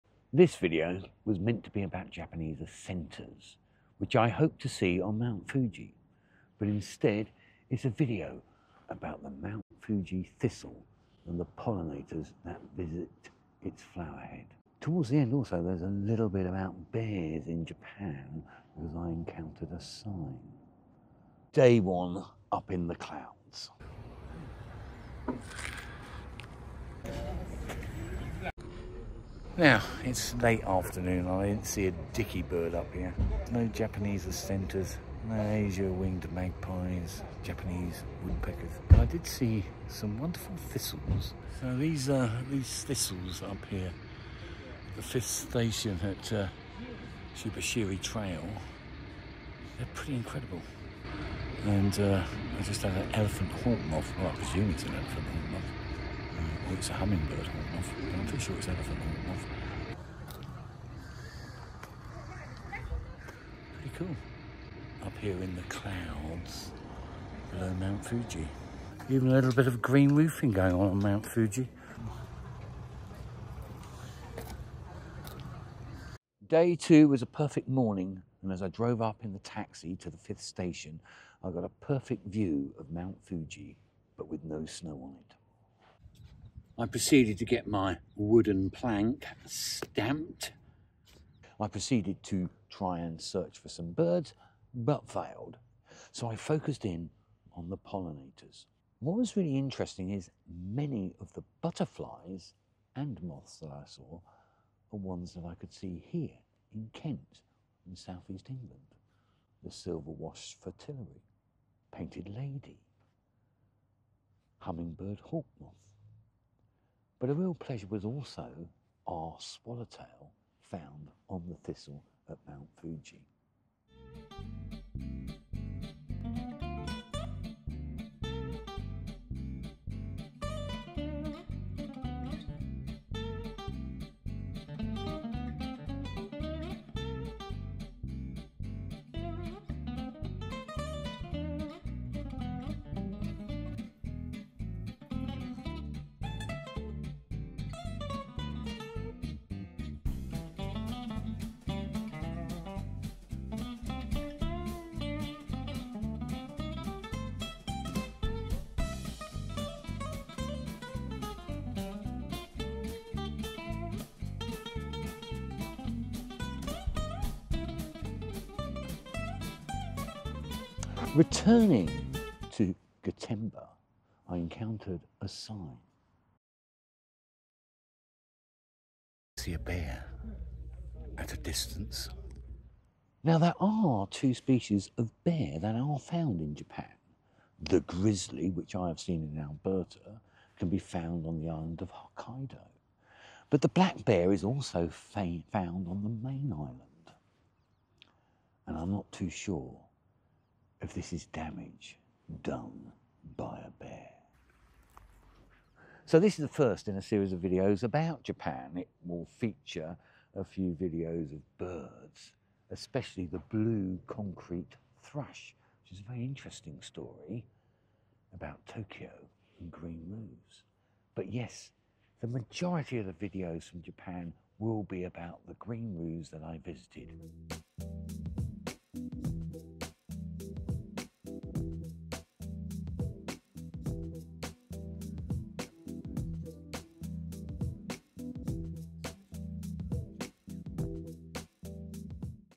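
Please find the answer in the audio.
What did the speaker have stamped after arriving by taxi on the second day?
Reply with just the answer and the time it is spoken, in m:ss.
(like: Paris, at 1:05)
wooden plank, at 1:28.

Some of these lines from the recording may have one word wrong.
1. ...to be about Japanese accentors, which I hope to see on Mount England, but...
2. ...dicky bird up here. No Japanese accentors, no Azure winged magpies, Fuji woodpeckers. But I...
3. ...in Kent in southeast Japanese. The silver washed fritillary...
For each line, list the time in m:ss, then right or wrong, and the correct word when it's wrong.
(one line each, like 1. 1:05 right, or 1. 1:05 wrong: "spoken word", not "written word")
1. 0:01 wrong: "Fuji", not "England"
2. 0:32 wrong: "Japanese", not "Fuji"
3. 1:46 wrong: "England", not "Japanese".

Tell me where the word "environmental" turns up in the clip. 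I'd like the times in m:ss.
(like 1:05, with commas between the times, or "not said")
not said.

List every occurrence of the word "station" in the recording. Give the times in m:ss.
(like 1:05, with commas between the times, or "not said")
0:45, 1:20.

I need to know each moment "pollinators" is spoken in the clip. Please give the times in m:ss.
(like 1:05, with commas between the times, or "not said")
0:11, 1:37.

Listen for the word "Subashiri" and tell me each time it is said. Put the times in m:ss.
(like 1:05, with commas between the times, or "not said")
0:47.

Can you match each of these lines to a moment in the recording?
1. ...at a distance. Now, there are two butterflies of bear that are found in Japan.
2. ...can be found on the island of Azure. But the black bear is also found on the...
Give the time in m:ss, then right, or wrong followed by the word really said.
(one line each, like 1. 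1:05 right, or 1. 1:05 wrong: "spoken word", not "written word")
1. 3:01 wrong: "species", not "butterflies"
2. 3:10 wrong: "Hokkaido", not "Azure".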